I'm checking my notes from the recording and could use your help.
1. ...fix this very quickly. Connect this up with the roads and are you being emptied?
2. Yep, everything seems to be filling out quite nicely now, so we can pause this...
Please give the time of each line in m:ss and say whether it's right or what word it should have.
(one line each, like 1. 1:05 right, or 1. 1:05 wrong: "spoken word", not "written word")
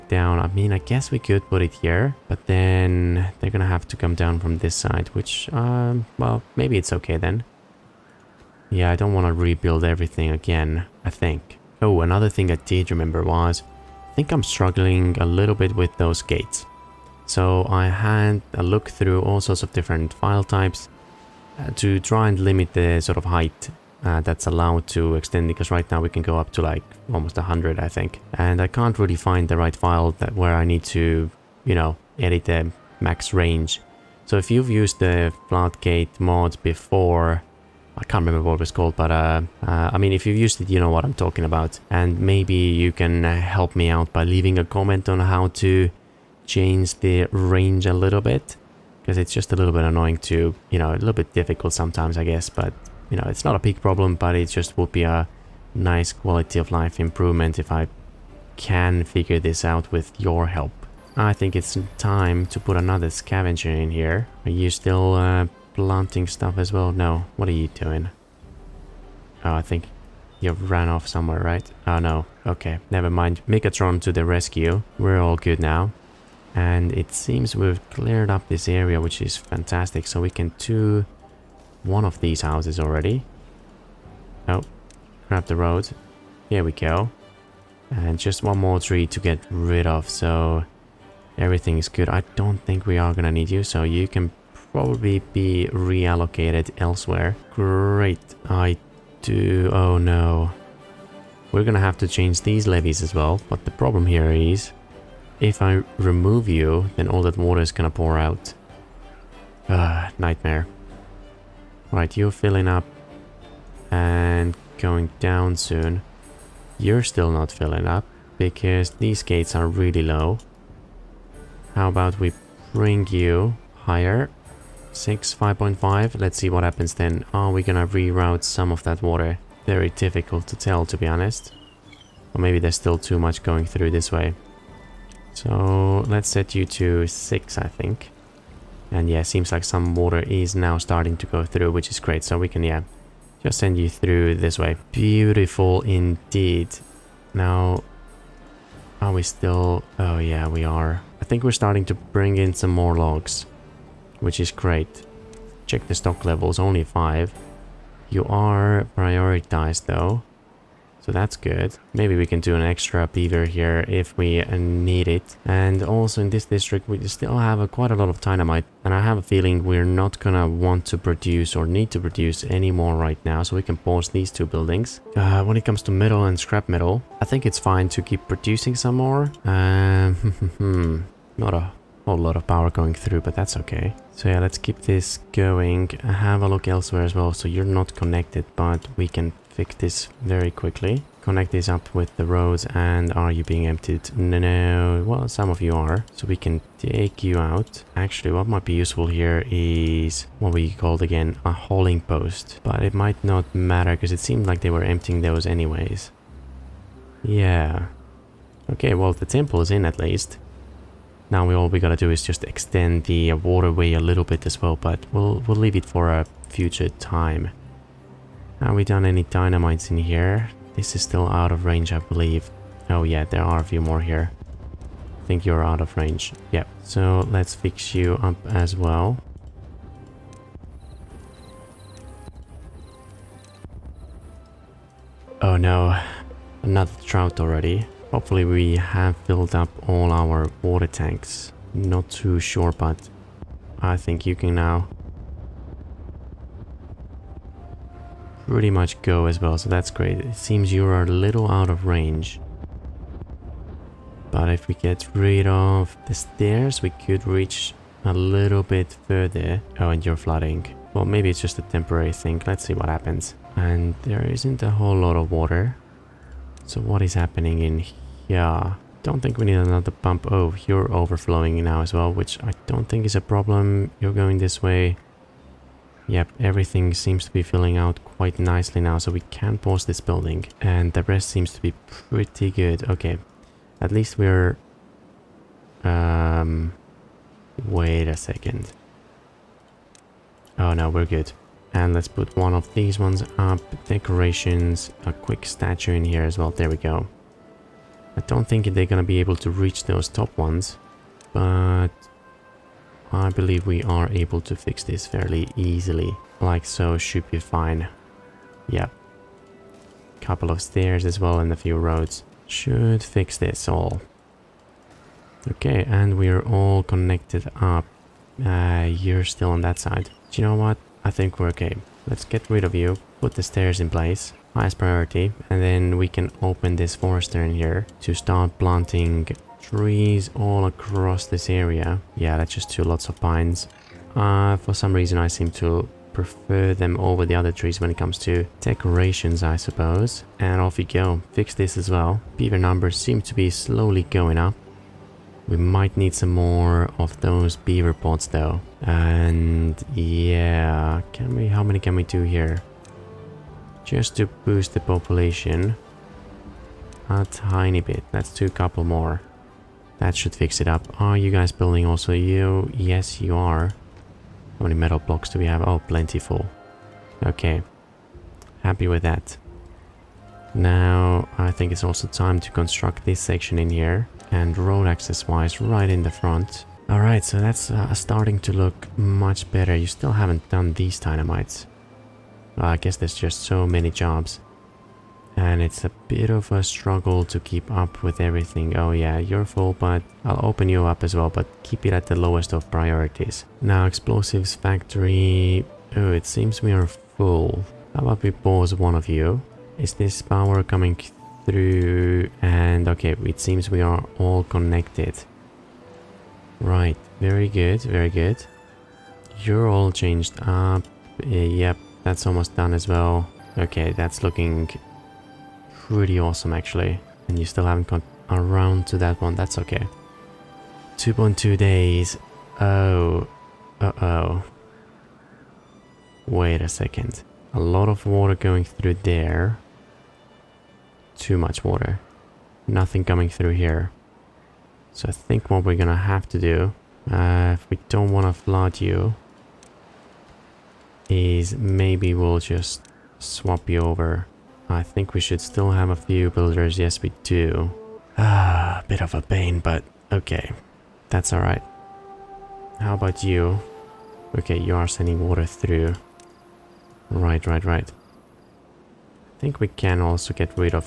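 1. 3:09 right
2. 4:36 right.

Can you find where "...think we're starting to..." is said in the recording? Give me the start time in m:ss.
2:31.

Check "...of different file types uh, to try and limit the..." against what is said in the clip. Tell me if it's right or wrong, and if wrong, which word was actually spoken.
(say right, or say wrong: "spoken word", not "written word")
right.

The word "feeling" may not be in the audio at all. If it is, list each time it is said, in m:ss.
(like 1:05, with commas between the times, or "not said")
2:49.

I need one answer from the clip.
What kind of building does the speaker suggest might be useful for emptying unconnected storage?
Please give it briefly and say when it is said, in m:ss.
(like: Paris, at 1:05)
A hauling post, at 3:21.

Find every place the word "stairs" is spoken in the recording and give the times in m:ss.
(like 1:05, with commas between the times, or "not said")
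4:16, 5:10, 5:23.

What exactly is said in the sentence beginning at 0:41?
And maybe you can uh, help me out by leaving a comment on how to change the range a little bit.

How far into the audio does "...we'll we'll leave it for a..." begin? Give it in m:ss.
3:35.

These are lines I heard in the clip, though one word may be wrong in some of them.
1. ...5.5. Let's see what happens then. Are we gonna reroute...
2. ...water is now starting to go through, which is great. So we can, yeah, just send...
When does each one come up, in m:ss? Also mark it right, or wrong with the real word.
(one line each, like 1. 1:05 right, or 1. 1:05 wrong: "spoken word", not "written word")
1. 2:05 right
2. 2:19 right.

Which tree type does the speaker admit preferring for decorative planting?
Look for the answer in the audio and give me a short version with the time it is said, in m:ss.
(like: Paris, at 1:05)
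Pines, at 5:33.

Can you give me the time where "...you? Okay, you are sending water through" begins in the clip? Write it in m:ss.
7:33.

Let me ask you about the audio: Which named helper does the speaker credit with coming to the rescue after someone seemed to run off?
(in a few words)
Megatron.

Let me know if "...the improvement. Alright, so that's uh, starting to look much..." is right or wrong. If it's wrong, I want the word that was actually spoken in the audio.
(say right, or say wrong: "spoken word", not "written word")
wrong: "front", not "improvement".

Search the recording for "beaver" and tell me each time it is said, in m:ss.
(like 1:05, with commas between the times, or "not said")
2:43, 5:42, 5:47.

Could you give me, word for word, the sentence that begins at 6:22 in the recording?
I guess there's just so many jobs.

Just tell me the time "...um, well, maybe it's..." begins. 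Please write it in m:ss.
0:05.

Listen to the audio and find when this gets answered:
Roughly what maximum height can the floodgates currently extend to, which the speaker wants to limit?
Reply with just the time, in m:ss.
0:27.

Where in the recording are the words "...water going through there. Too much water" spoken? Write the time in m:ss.
7:08.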